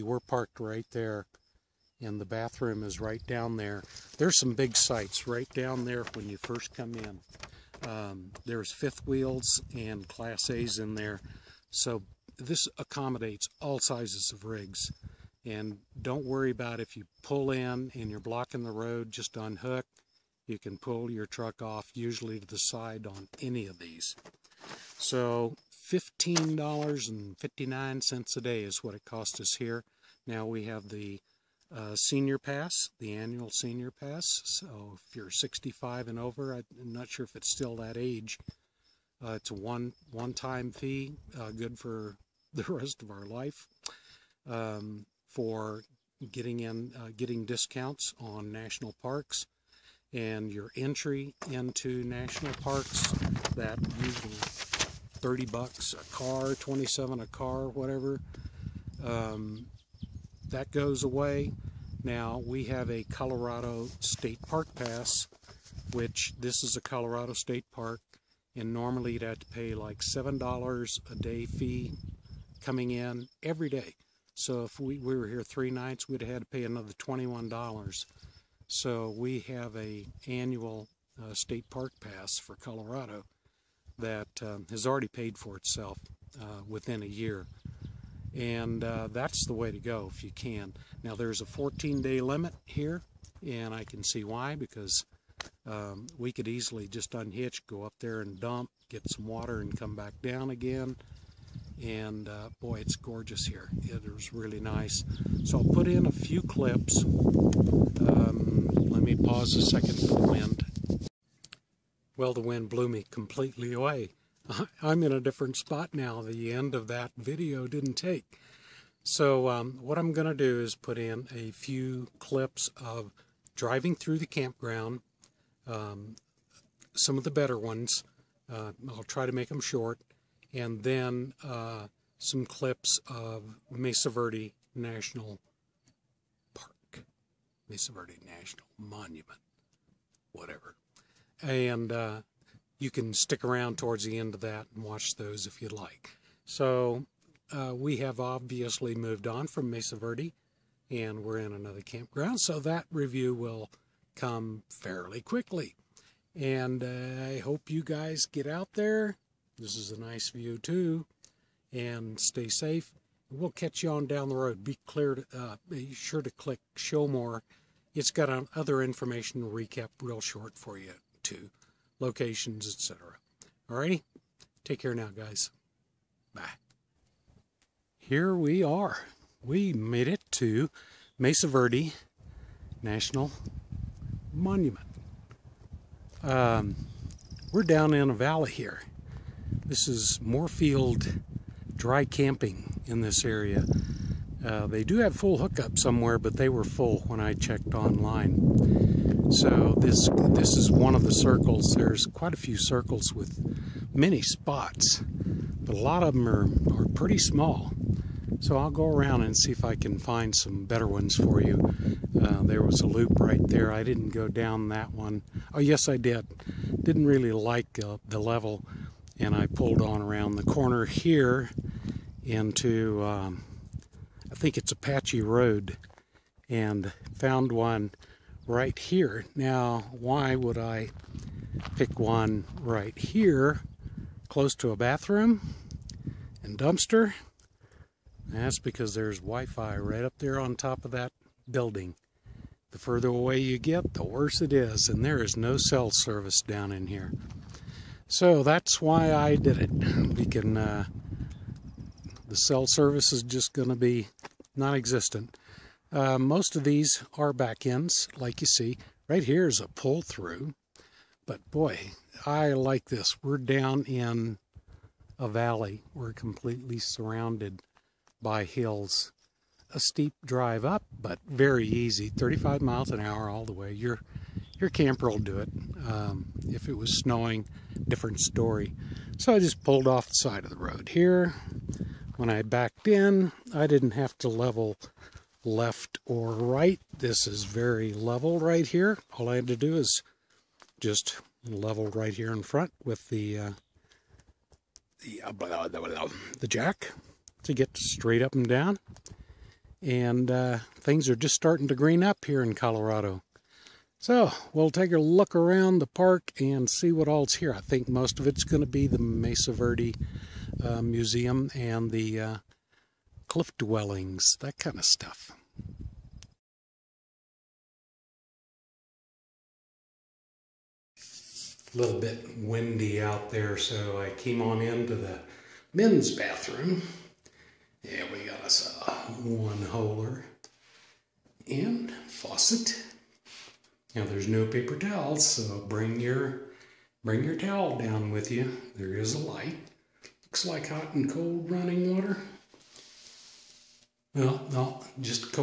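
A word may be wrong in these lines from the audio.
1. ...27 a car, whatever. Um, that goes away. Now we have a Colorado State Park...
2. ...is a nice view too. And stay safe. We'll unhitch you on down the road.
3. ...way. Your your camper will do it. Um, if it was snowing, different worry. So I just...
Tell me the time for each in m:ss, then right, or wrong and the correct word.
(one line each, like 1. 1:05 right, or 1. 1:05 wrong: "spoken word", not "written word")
1. 0:56 right
2. 2:39 wrong: "catch", not "unhitch"
3. 4:33 wrong: "story", not "worry".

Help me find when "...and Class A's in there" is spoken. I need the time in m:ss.
0:09.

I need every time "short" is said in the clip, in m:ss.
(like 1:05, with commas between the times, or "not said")
2:09, 2:50.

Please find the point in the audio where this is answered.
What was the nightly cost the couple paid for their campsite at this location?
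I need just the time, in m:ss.
0:25.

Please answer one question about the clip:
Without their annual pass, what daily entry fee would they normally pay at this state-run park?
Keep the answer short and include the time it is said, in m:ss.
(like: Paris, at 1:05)
$7, at 1:10.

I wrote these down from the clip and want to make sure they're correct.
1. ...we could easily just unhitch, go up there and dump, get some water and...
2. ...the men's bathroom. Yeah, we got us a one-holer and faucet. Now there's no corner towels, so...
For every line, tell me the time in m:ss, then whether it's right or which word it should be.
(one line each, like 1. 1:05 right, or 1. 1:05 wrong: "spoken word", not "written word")
1. 1:36 right
2. 5:24 wrong: "paper", not "corner".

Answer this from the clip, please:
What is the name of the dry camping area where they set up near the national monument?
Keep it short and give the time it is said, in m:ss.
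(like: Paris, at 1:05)
Morefield, at 3:10.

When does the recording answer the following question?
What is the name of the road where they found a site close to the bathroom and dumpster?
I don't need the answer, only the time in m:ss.
3:44.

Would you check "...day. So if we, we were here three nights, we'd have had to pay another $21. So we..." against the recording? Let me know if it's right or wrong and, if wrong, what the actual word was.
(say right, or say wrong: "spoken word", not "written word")
right.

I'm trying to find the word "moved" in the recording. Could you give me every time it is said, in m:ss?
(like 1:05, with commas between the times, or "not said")
2:28.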